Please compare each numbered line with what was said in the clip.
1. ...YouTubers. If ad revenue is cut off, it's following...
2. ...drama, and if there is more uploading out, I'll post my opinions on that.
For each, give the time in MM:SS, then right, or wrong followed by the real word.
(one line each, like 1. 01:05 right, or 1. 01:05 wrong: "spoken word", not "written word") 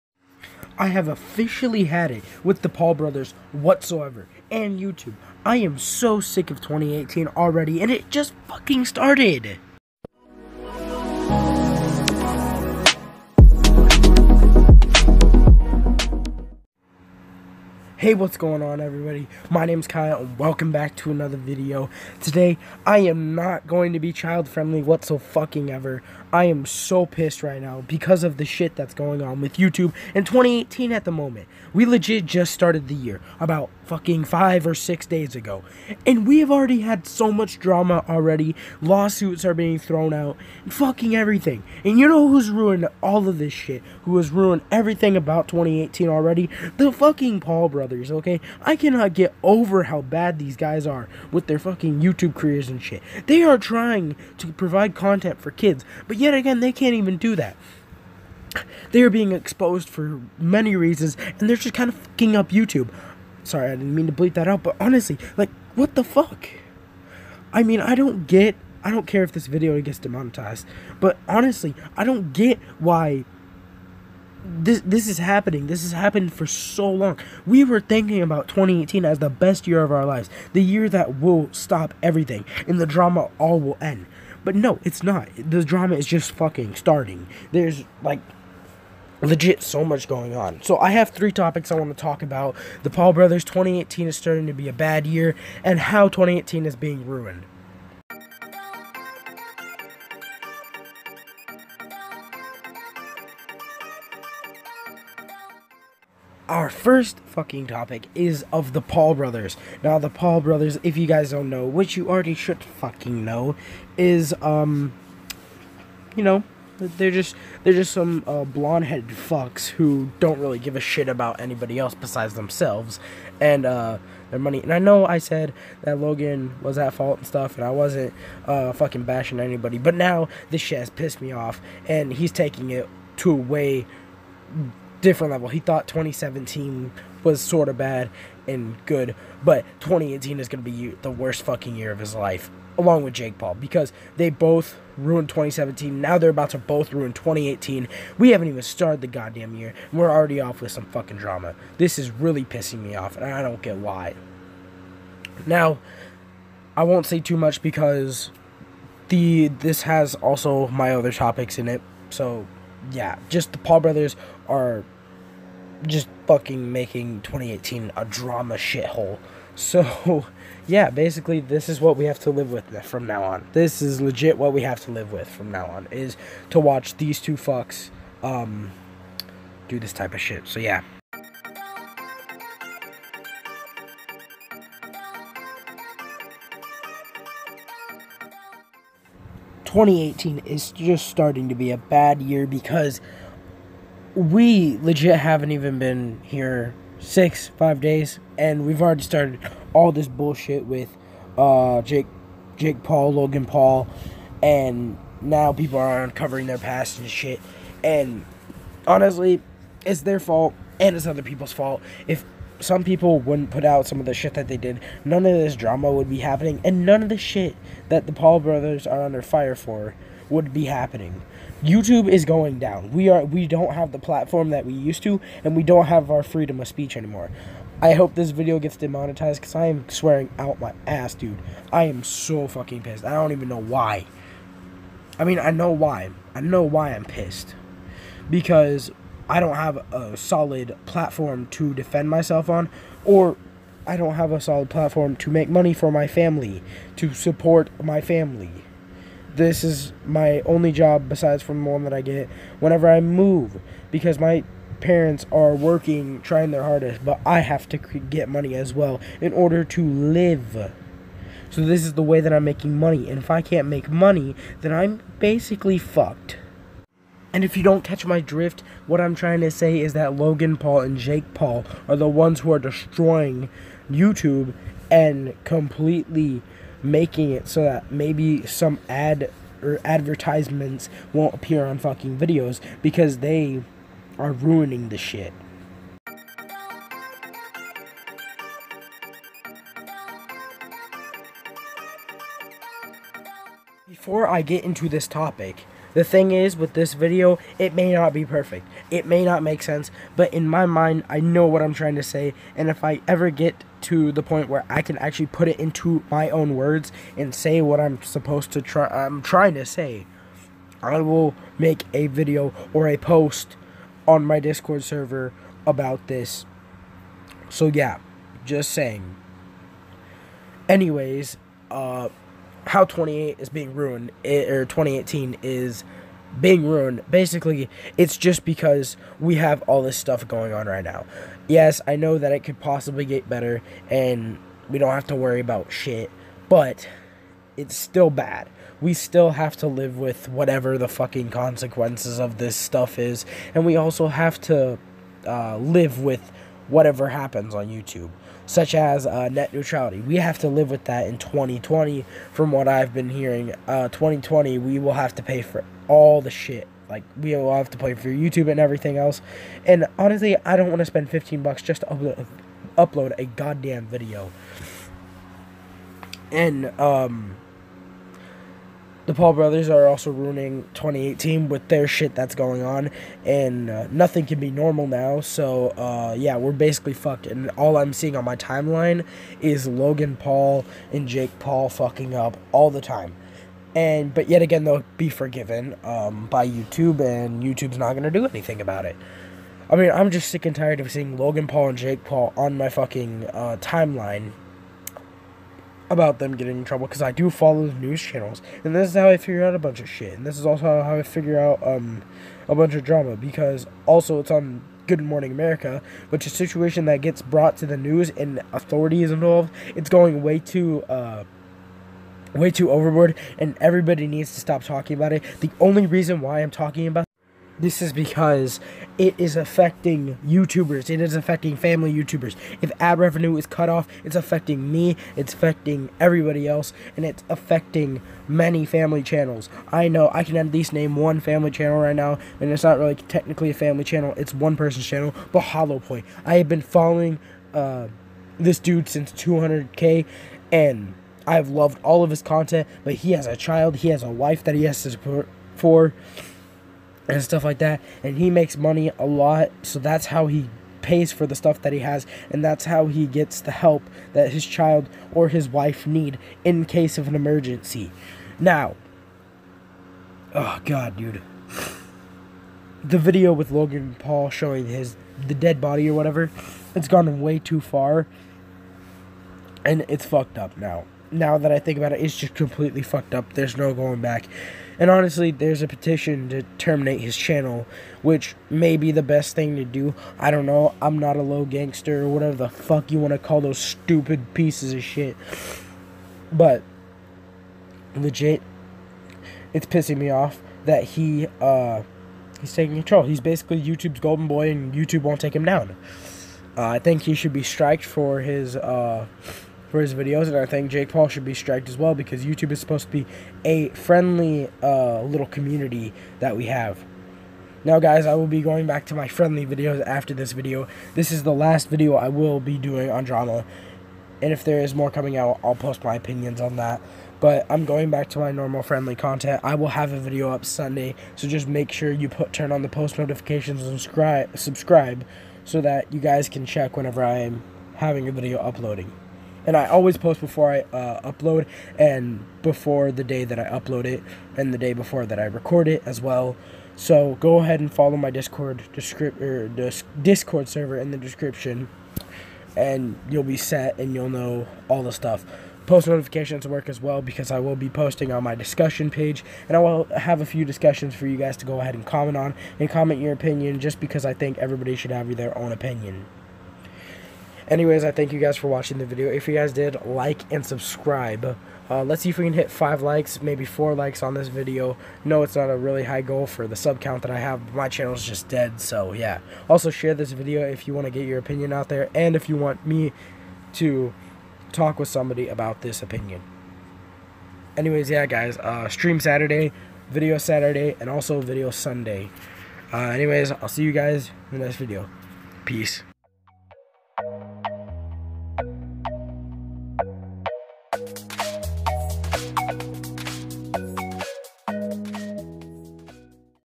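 1. 07:01 wrong: "affecting", not "following"
2. 08:33 wrong: "coming", not "uploading".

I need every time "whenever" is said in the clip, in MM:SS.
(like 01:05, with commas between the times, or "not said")
04:12, 08:46.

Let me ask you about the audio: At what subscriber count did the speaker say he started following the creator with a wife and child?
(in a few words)
200k.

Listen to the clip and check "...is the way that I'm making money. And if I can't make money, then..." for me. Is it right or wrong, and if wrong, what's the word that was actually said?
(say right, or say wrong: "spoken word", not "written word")
right.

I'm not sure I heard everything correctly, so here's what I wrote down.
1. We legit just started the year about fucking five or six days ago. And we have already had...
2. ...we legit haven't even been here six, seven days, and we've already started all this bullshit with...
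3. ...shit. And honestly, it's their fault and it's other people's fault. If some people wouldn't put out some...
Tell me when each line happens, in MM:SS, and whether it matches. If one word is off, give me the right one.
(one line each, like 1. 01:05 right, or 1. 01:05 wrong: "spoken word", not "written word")
1. 00:31 right
2. 03:14 wrong: "five", not "seven"
3. 03:27 right.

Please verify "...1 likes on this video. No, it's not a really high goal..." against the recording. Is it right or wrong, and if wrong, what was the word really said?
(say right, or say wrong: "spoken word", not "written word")
wrong: "4", not "1".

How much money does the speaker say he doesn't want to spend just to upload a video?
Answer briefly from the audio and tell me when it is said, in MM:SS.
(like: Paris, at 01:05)
15 bucks, at 06:01.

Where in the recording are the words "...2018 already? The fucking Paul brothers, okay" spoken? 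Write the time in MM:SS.
00:45.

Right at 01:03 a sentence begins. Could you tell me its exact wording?
Sorry, I didn't mean to bleep that out, but honestly, like, what the fuck?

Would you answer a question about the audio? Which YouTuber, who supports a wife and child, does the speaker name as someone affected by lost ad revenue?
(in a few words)
Hollow Point.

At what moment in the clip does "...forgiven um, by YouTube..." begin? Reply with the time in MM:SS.
06:25.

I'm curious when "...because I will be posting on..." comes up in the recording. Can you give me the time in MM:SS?
09:07.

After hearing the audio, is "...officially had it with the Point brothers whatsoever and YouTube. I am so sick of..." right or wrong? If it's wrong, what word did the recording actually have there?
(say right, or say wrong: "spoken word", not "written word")
wrong: "Paul", not "Point".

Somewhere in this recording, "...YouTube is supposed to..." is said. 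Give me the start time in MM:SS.
08:22.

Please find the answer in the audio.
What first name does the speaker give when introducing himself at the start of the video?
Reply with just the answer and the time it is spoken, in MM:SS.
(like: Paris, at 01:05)
Kyle, at 00:19.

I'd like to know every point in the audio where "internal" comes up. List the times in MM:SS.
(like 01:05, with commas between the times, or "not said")
not said.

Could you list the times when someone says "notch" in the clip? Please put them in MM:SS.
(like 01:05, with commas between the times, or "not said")
not said.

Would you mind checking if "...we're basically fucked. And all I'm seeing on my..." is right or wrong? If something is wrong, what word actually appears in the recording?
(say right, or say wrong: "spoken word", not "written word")
right.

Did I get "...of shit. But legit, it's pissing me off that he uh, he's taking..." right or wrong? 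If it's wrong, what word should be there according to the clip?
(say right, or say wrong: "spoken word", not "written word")
right.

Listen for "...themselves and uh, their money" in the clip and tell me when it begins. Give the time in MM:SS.
02:02.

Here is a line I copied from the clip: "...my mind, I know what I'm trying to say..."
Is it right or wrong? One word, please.
right.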